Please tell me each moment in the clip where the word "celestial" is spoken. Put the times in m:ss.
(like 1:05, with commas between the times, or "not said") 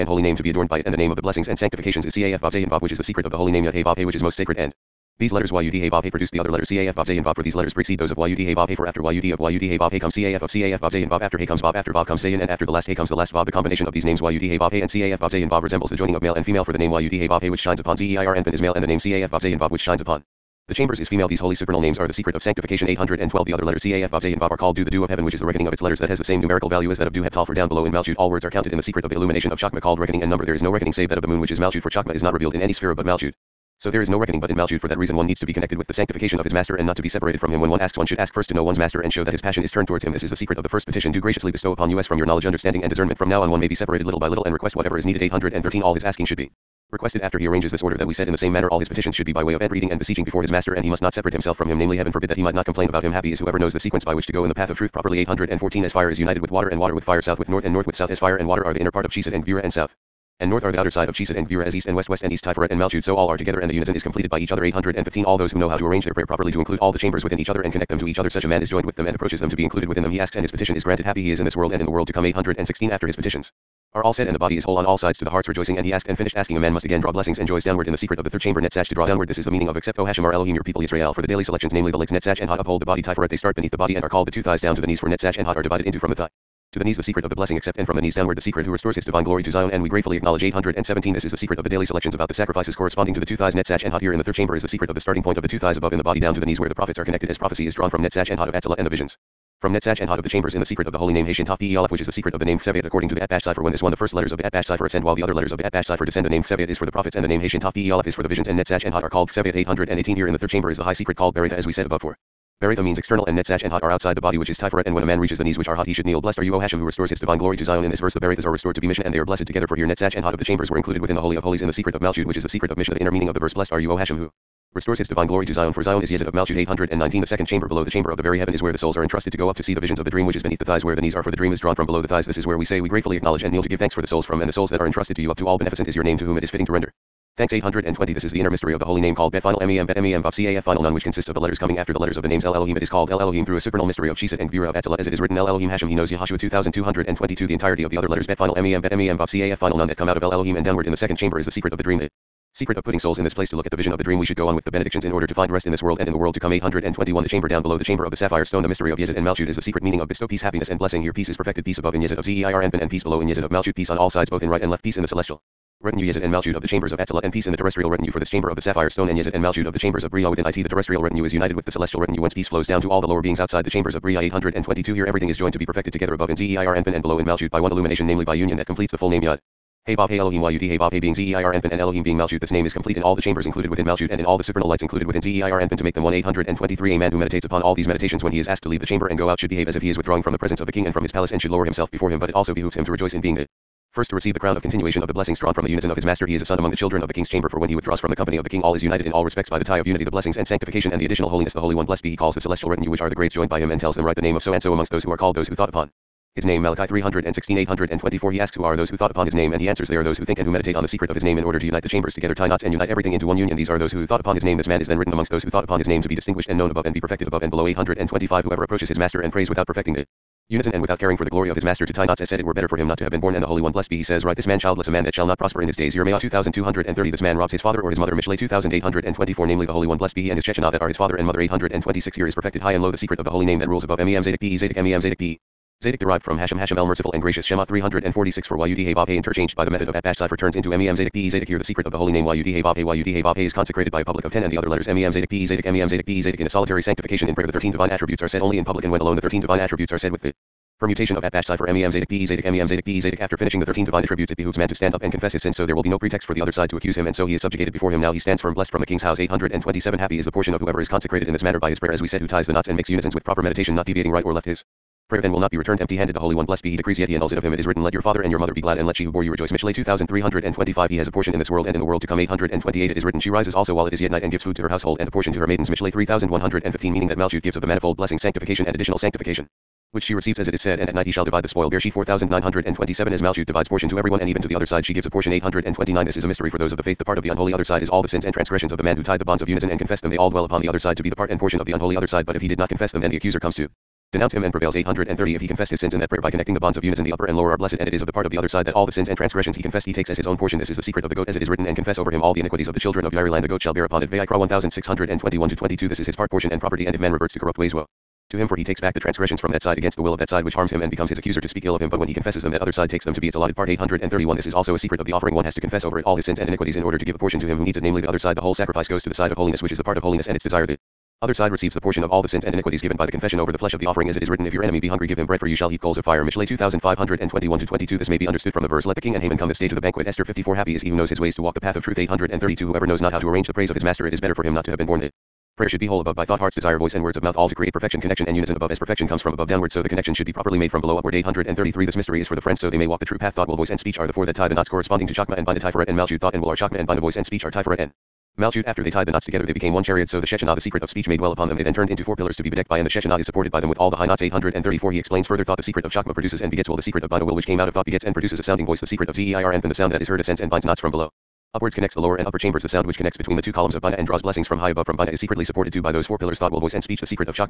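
2:45, 2:51, 3:22.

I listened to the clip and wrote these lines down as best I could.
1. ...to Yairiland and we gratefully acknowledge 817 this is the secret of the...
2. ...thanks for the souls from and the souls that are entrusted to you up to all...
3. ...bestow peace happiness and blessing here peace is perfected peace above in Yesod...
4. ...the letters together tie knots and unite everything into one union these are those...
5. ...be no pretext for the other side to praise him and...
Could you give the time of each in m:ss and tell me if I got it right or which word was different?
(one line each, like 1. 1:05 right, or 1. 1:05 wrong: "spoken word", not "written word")
1. 1:29 wrong: "Zion", not "Yairiland"
2. 2:13 right
3. 2:40 right
4. 3:31 wrong: "chambers", not "letters"
5. 4:15 wrong: "accuse", not "praise".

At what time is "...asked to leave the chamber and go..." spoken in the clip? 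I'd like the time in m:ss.
3:08.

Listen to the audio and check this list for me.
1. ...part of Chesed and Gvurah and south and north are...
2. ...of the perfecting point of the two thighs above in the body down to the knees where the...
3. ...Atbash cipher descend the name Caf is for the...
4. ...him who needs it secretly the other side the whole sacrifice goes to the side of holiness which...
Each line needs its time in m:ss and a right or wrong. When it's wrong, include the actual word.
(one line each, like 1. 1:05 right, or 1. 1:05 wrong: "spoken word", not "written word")
1. 0:58 right
2. 1:34 wrong: "starting", not "perfecting"
3. 1:45 wrong: "Seviot", not "Caf"
4. 5:17 wrong: "namely", not "secretly".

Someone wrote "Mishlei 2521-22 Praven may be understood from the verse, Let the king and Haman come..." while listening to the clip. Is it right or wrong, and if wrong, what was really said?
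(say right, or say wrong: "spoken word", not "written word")
wrong: "This", not "Praven".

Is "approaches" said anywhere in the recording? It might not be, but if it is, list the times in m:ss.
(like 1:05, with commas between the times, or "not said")
1:09, 3:38.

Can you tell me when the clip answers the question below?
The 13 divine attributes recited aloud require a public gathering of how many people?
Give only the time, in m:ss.
4:03.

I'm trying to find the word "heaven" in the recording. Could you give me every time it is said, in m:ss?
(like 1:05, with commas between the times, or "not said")
0:25, 0:51, 2:08.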